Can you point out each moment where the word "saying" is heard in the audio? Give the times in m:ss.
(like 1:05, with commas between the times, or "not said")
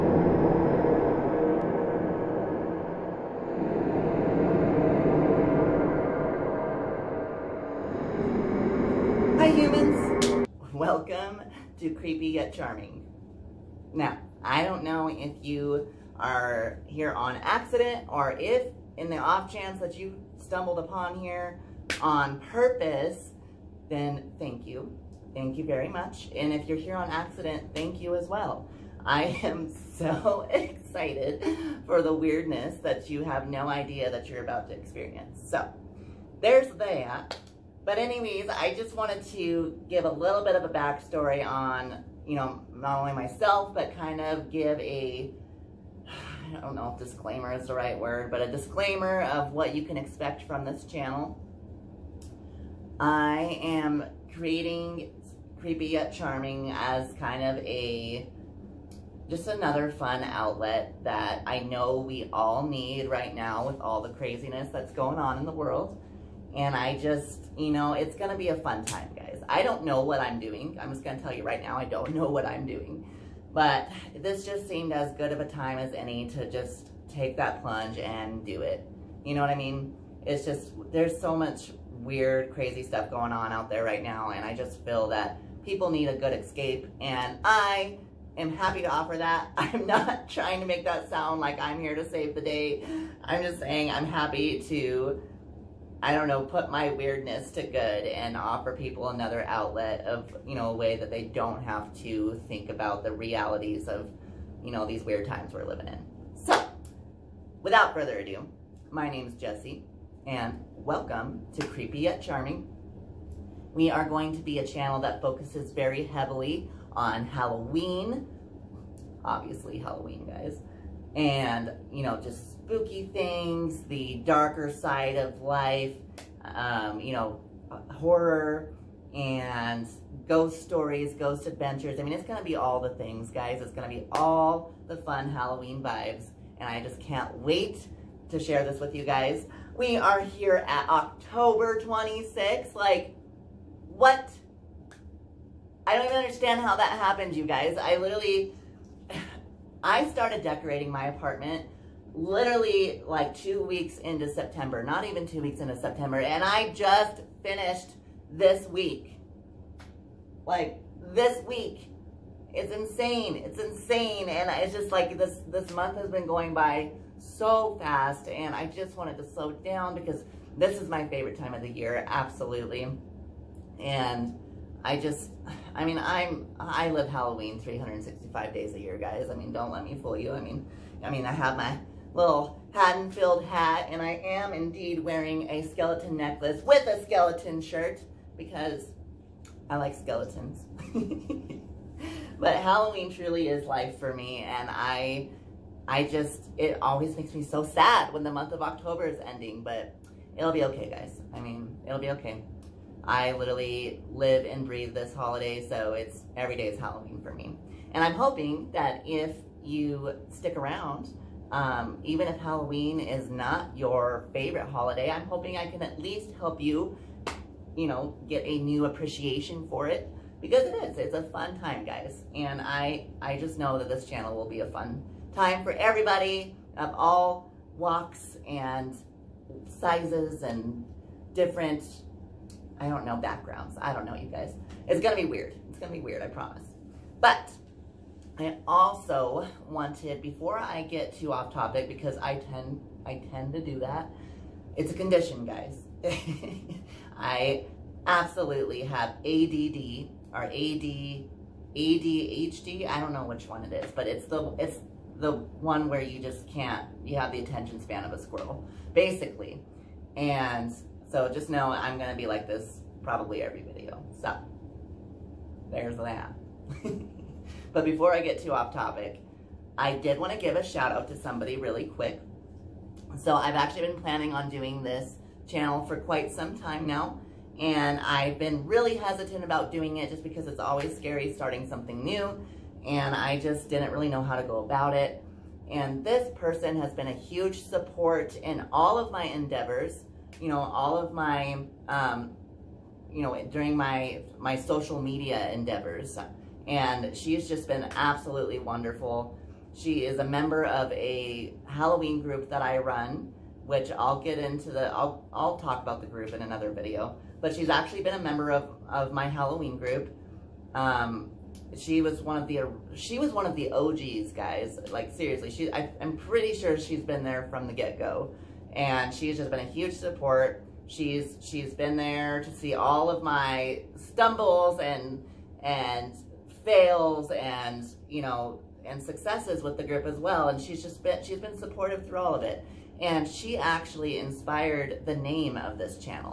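1:33.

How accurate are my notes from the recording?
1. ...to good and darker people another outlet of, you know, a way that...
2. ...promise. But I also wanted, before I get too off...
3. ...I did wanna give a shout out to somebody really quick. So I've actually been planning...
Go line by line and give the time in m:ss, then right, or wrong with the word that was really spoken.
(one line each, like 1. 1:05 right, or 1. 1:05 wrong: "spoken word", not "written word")
1. 1:37 wrong: "offer", not "darker"
2. 3:56 right
3. 4:29 right.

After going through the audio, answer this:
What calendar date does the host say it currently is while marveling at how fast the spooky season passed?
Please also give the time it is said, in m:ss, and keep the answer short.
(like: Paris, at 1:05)
October 26th, at 2:20.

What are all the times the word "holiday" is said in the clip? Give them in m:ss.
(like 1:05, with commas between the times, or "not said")
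3:25, 3:34.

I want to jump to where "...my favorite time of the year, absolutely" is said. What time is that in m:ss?
2:50.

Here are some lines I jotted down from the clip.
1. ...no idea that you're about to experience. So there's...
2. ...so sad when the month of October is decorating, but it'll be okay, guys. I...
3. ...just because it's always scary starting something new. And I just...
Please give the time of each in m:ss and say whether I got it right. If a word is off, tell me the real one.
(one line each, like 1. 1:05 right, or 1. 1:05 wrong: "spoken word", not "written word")
1. 0:33 right
2. 3:17 wrong: "ending", not "decorating"
3. 4:40 right.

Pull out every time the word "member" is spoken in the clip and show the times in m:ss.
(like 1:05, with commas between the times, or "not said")
5:00, 5:08.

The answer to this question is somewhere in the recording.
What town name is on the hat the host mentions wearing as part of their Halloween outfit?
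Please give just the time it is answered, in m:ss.
3:02.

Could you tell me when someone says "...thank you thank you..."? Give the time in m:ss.
0:24.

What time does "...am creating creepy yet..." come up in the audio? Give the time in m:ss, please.
0:53.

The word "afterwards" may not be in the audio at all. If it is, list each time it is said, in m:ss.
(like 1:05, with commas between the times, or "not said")
not said.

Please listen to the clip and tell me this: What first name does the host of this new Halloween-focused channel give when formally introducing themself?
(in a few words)
Jesse.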